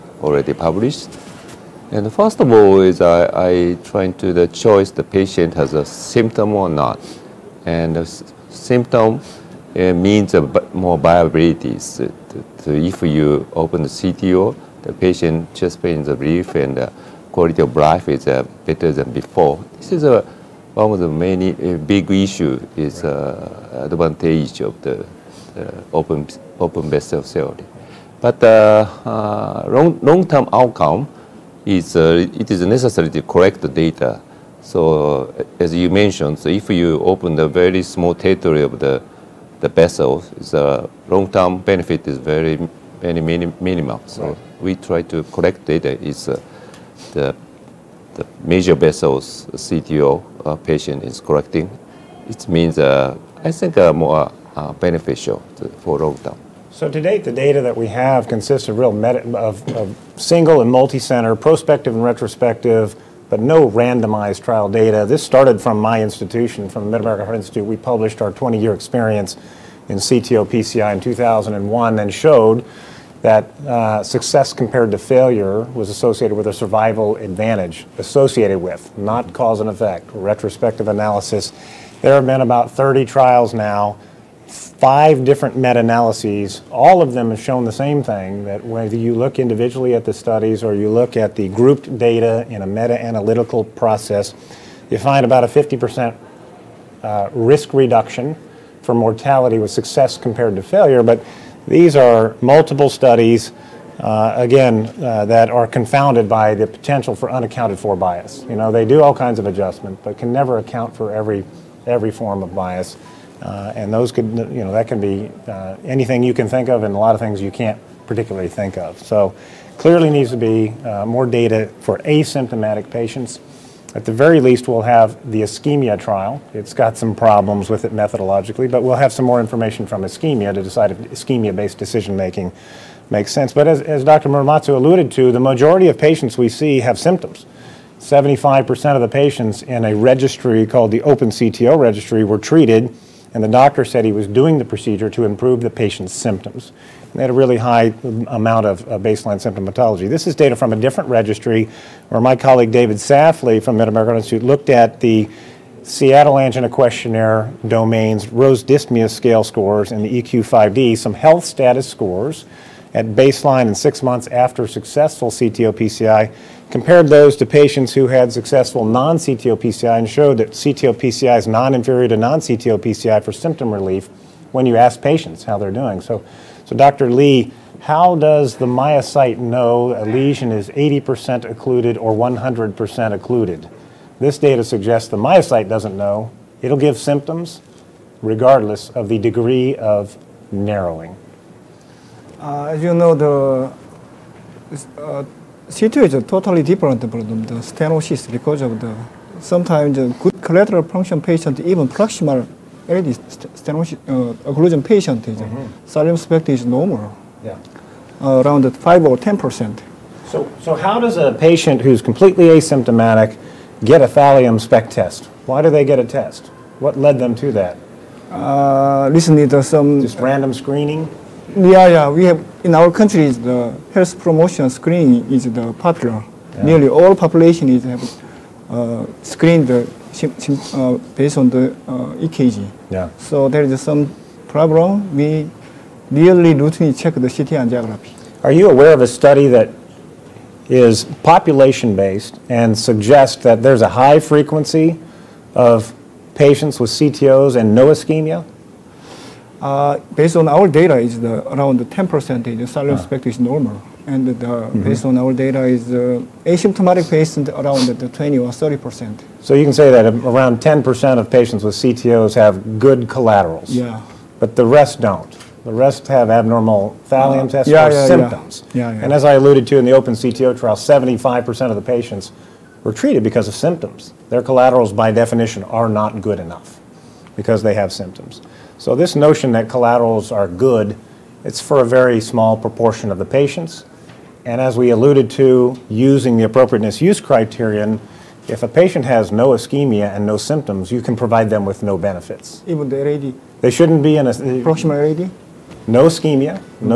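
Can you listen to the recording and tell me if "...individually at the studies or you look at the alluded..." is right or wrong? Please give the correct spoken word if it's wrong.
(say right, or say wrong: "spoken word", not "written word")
wrong: "grouped", not "alluded".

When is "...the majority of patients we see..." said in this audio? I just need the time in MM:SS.
02:15.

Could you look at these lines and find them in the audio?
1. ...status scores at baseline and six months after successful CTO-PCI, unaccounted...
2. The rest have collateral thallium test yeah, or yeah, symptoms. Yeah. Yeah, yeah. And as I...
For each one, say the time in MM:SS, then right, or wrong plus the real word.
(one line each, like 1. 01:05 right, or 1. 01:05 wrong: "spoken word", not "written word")
1. 02:41 wrong: "compared", not "unaccounted"
2. 04:25 wrong: "abnormal", not "collateral".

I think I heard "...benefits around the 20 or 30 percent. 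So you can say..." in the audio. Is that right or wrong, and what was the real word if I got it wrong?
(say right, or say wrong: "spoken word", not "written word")
wrong: "patients", not "benefits".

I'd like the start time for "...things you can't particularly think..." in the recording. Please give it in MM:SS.
01:57.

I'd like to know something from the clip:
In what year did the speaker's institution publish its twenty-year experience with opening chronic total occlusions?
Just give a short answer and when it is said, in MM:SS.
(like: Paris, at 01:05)
2001, at 01:10.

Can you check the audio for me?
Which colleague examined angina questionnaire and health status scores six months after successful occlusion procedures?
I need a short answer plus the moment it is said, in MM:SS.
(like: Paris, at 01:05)
David Safley, at 02:32.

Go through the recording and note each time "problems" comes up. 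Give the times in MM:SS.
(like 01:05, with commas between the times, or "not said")
02:07, 03:54.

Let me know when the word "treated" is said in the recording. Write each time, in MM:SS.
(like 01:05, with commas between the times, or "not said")
02:22, 04:32.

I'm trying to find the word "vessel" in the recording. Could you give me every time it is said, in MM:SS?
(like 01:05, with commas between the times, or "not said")
00:26, 00:39, 00:48.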